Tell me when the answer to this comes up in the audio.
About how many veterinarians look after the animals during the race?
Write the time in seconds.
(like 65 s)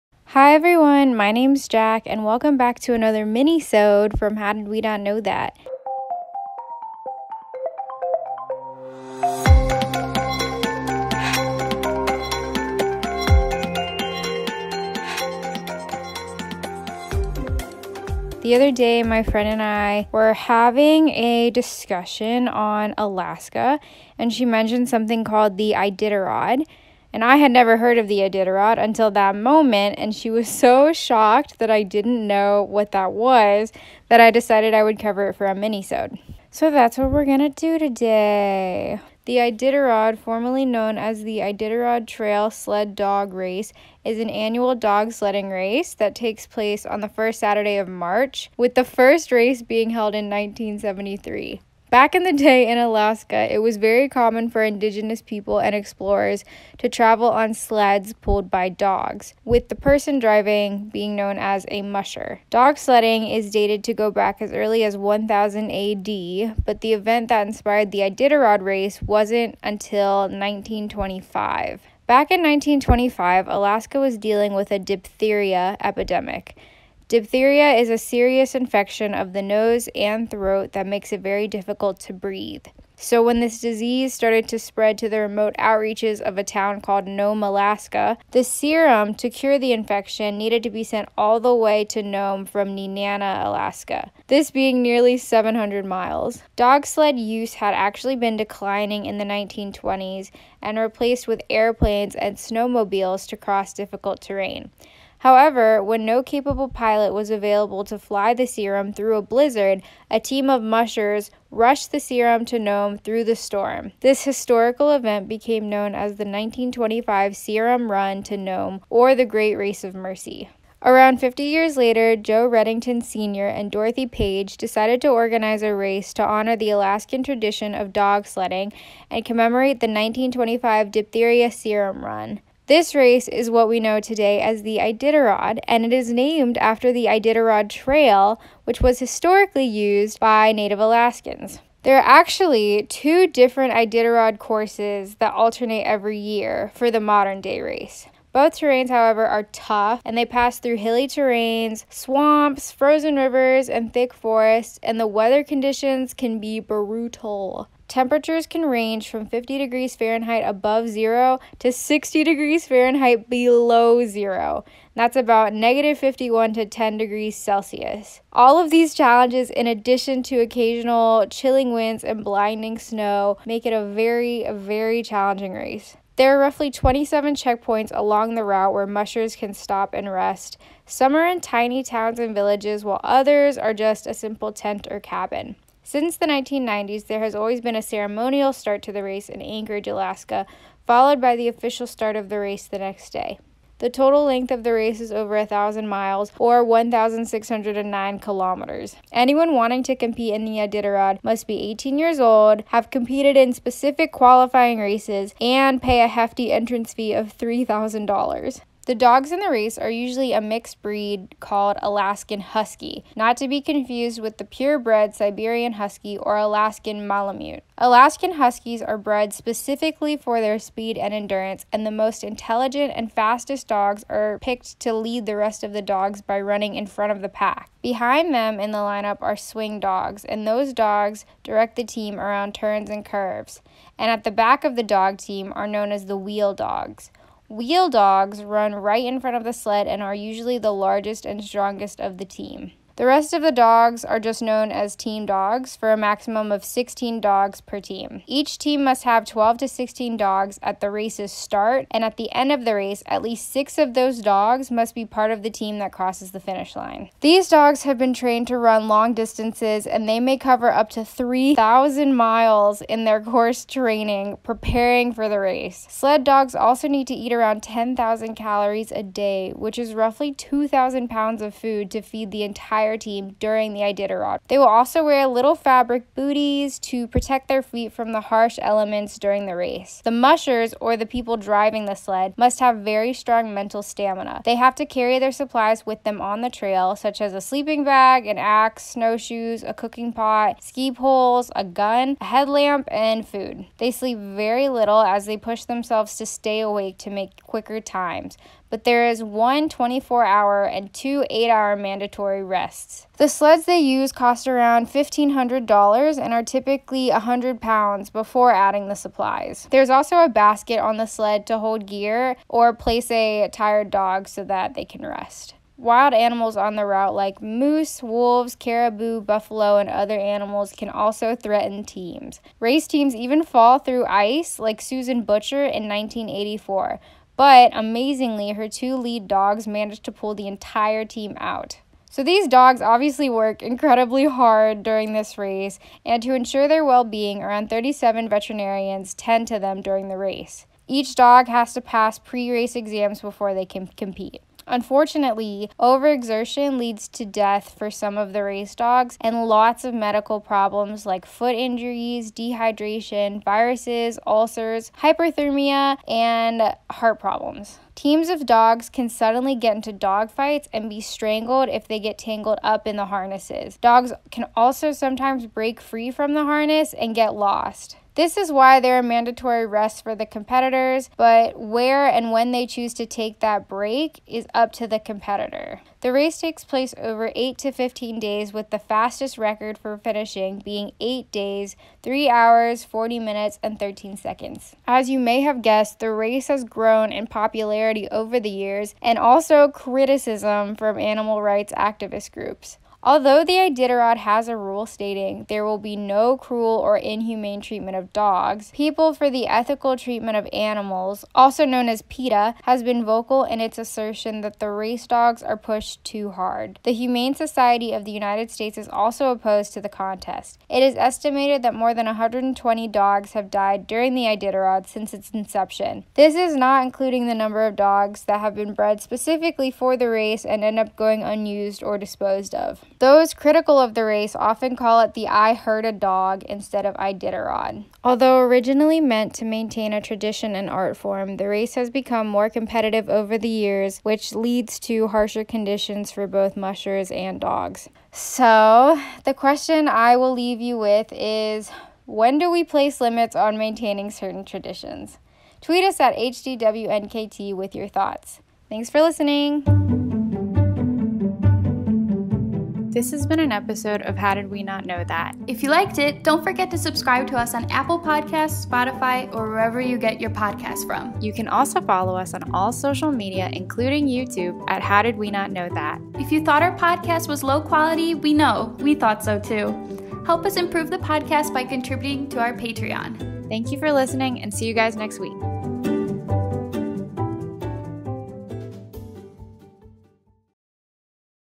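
337 s.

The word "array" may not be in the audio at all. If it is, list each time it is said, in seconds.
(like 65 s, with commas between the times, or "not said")
not said.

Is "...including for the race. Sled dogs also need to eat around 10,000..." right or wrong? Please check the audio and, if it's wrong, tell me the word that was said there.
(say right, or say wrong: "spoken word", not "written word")
wrong: "preparing", not "including".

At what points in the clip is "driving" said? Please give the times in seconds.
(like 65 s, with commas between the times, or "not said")
60 s, 281 s.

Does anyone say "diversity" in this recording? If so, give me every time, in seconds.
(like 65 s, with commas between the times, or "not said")
not said.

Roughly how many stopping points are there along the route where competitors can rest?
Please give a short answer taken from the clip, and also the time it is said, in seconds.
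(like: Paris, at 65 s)
27, at 176 s.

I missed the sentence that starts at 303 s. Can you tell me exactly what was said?
The sleds they use cost around $1,500 and are typically 100 pounds before adding the supplies.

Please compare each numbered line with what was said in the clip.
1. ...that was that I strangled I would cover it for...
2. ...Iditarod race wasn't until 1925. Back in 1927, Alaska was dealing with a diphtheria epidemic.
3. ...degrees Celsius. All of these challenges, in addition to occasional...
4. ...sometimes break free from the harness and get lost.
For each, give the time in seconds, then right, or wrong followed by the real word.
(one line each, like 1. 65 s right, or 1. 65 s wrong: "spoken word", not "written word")
1. 32 s wrong: "decided", not "strangled"
2. 68 s wrong: "1925", not "1927"
3. 166 s right
4. 364 s right.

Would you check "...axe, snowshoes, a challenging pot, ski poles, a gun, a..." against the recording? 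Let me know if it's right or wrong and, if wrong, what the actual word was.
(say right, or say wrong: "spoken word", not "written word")
wrong: "cooking", not "challenging".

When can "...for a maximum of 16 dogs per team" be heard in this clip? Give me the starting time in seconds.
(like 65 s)
245 s.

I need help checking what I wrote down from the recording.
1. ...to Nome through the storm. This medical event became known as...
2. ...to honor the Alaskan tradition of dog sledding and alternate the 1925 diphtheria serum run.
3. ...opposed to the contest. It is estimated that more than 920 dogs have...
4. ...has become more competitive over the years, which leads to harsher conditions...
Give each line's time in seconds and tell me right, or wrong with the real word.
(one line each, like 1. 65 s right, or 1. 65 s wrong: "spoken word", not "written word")
1. 112 s wrong: "historical", not "medical"
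2. 126 s wrong: "commemorate", not "alternate"
3. 409 s wrong: "120", not "920"
4. 431 s right.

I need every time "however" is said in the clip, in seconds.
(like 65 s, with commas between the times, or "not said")
105 s, 148 s.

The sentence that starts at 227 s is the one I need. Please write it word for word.
Behind them in the lineup are swing dogs, and those dogs direct the team around turns and curves.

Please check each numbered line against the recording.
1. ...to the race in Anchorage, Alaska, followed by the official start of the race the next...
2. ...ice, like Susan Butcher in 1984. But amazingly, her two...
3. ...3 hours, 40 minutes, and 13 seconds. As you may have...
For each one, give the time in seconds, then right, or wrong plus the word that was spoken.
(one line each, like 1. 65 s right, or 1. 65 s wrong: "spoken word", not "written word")
1. 188 s right
2. 324 s right
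3. 382 s right.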